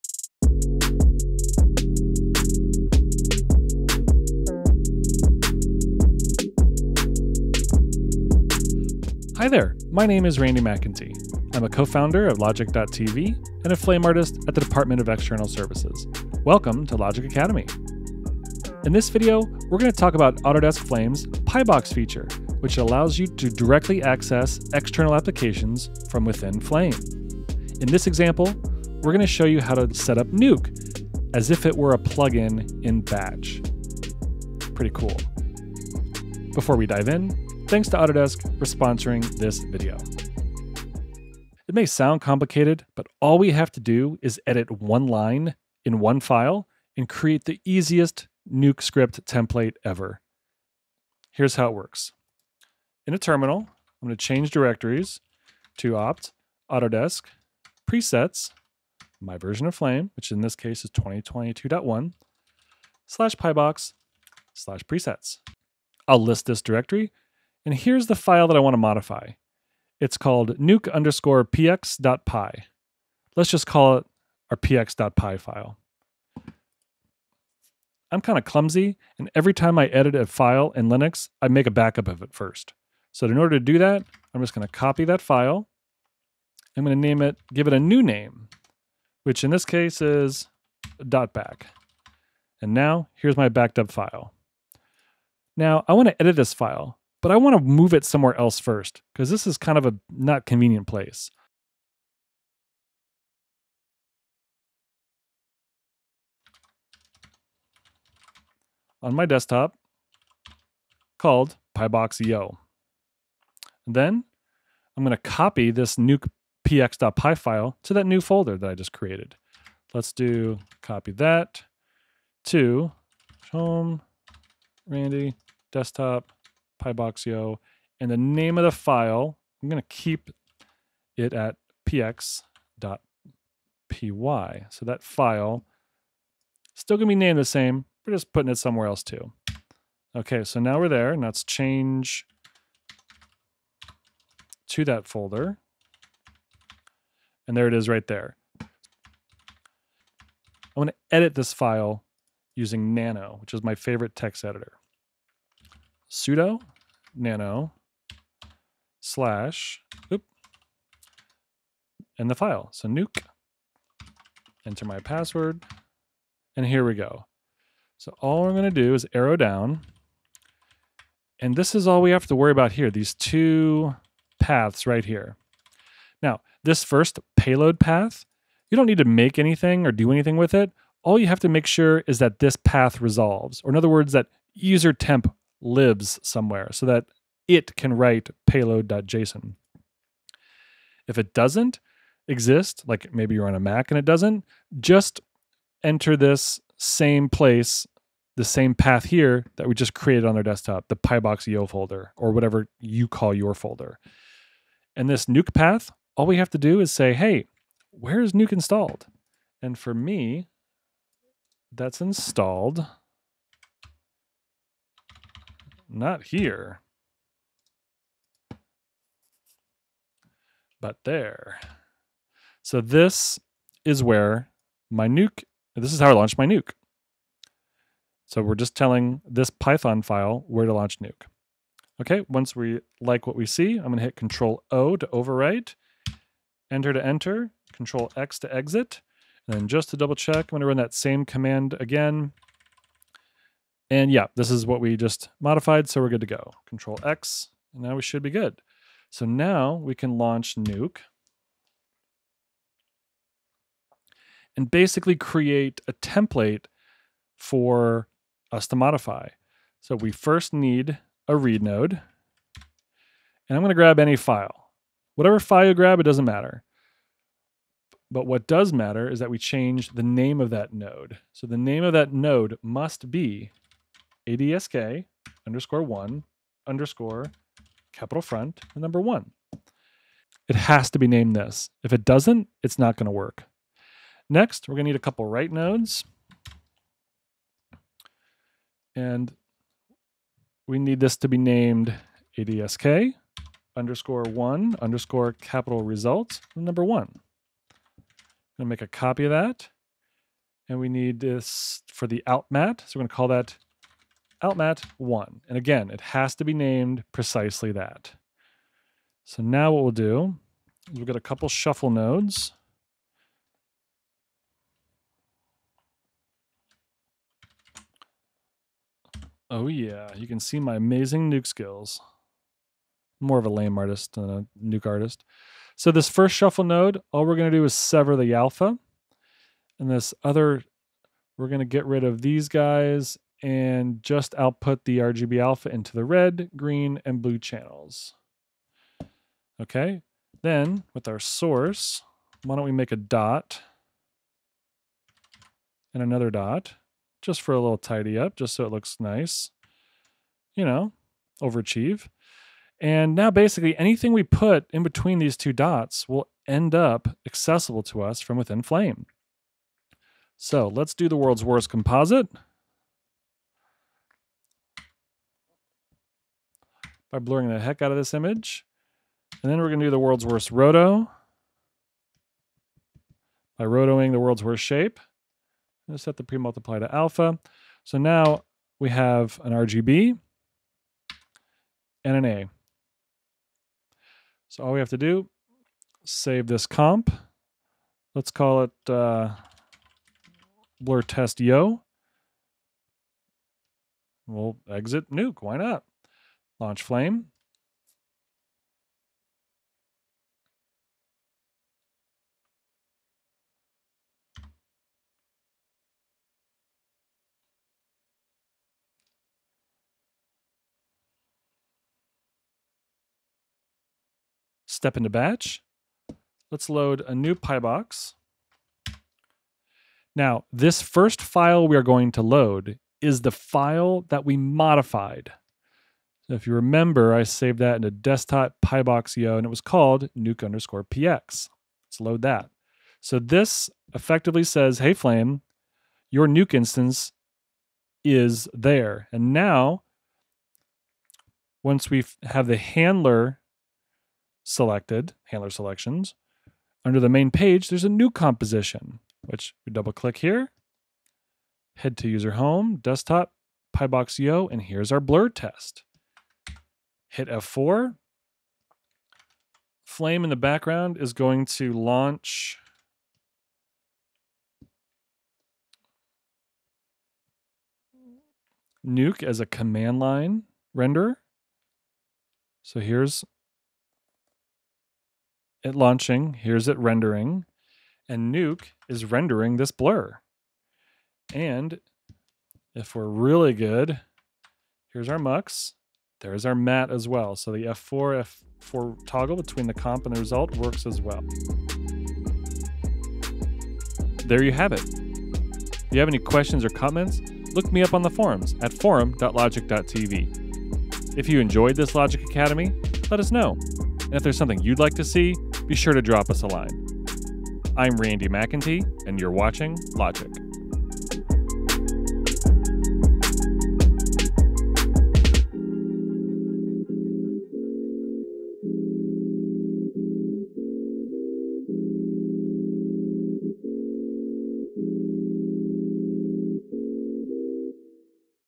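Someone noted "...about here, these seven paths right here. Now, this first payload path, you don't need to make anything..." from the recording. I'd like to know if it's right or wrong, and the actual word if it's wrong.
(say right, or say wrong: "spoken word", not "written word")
wrong: "two", not "seven".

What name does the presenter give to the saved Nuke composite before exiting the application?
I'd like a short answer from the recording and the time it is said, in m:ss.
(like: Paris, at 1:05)
blur test yo, at 6:30.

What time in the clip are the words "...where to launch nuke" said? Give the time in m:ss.
3:50.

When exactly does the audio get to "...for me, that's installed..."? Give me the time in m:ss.
3:29.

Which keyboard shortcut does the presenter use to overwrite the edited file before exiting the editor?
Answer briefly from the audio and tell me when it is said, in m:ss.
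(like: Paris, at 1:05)
Control O, at 3:54.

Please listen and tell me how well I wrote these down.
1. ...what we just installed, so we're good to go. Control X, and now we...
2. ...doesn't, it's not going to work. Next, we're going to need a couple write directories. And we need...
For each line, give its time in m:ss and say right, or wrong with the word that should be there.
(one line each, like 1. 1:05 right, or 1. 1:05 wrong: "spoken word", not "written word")
1. 4:04 wrong: "modified", not "installed"
2. 4:42 wrong: "nodes", not "directories".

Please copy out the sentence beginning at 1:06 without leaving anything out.
I'll list this directory and here's the file that I want to modify.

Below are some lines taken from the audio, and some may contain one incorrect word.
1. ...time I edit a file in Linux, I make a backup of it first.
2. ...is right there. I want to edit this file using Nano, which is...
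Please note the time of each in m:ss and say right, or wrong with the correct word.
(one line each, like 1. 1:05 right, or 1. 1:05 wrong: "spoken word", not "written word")
1. 1:19 right
2. 2:27 right.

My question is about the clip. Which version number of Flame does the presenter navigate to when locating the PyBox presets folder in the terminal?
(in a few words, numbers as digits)
2022.1.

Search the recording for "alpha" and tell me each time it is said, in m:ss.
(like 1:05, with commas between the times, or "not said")
5:28, 5:35, 6:16.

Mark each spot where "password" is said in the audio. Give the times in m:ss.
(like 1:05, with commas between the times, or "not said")
2:44.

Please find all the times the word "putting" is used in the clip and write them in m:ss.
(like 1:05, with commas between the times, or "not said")
2:18.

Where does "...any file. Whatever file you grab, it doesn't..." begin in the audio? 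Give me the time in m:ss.
4:23.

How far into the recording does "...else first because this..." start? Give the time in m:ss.
1:38.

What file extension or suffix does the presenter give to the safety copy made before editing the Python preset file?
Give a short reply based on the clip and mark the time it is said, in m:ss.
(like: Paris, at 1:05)
.back, at 1:31.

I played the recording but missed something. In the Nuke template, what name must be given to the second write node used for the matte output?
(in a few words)
outmat1.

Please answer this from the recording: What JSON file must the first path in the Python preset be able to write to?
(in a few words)
payload.json.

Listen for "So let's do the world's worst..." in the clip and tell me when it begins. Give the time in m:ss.
6:00.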